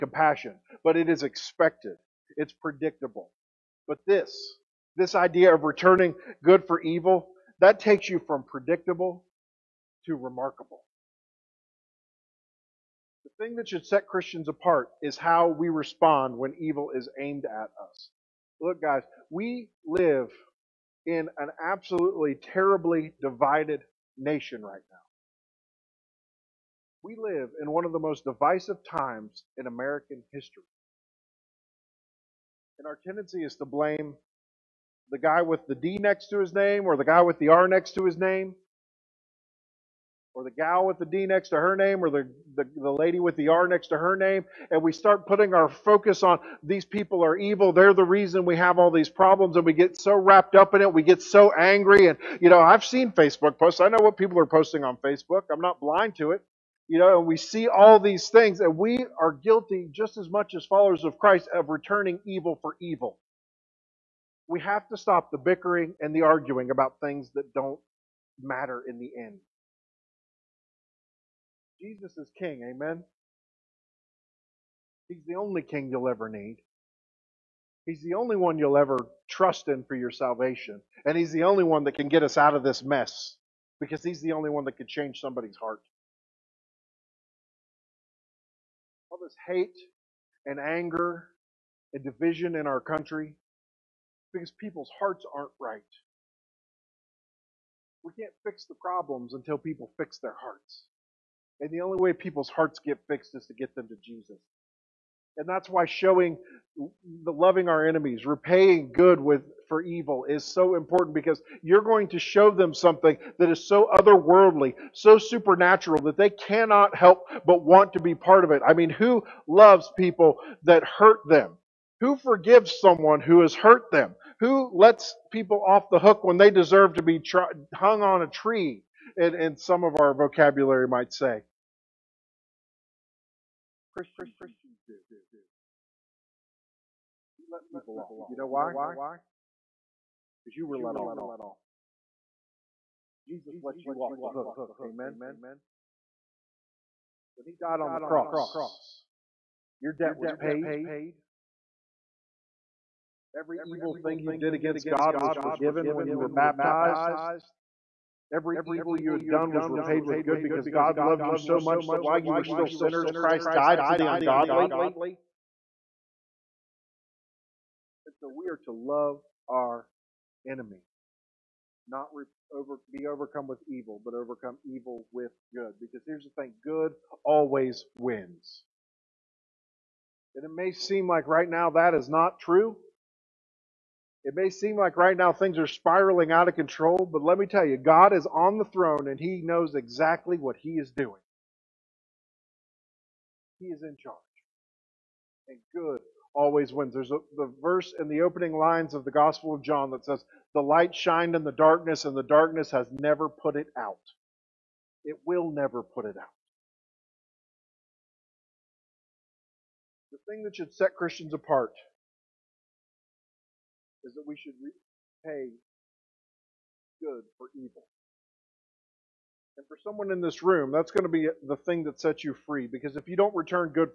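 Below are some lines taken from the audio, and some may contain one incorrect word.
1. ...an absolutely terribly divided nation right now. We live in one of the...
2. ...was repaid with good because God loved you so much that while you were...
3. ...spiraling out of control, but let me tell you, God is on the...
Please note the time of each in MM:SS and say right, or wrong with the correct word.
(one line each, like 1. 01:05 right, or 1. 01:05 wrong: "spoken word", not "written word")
1. 00:21 right
2. 02:39 right
3. 03:05 right.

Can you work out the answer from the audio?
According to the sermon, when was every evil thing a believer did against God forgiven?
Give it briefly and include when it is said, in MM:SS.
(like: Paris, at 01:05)
when you were baptized, at 02:35.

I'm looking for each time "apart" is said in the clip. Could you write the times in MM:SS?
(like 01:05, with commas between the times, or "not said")
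00:14, 03:31.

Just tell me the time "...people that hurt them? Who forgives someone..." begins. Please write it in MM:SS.
01:59.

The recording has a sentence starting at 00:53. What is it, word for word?
I know what people are posting on Facebook.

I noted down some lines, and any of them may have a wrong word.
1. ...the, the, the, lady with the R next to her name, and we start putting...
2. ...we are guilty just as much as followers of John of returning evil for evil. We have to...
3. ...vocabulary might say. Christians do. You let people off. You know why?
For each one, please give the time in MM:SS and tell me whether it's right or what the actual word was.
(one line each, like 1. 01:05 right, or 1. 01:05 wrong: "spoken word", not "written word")
1. 00:42 right
2. 00:58 wrong: "Christ", not "John"
3. 02:10 right.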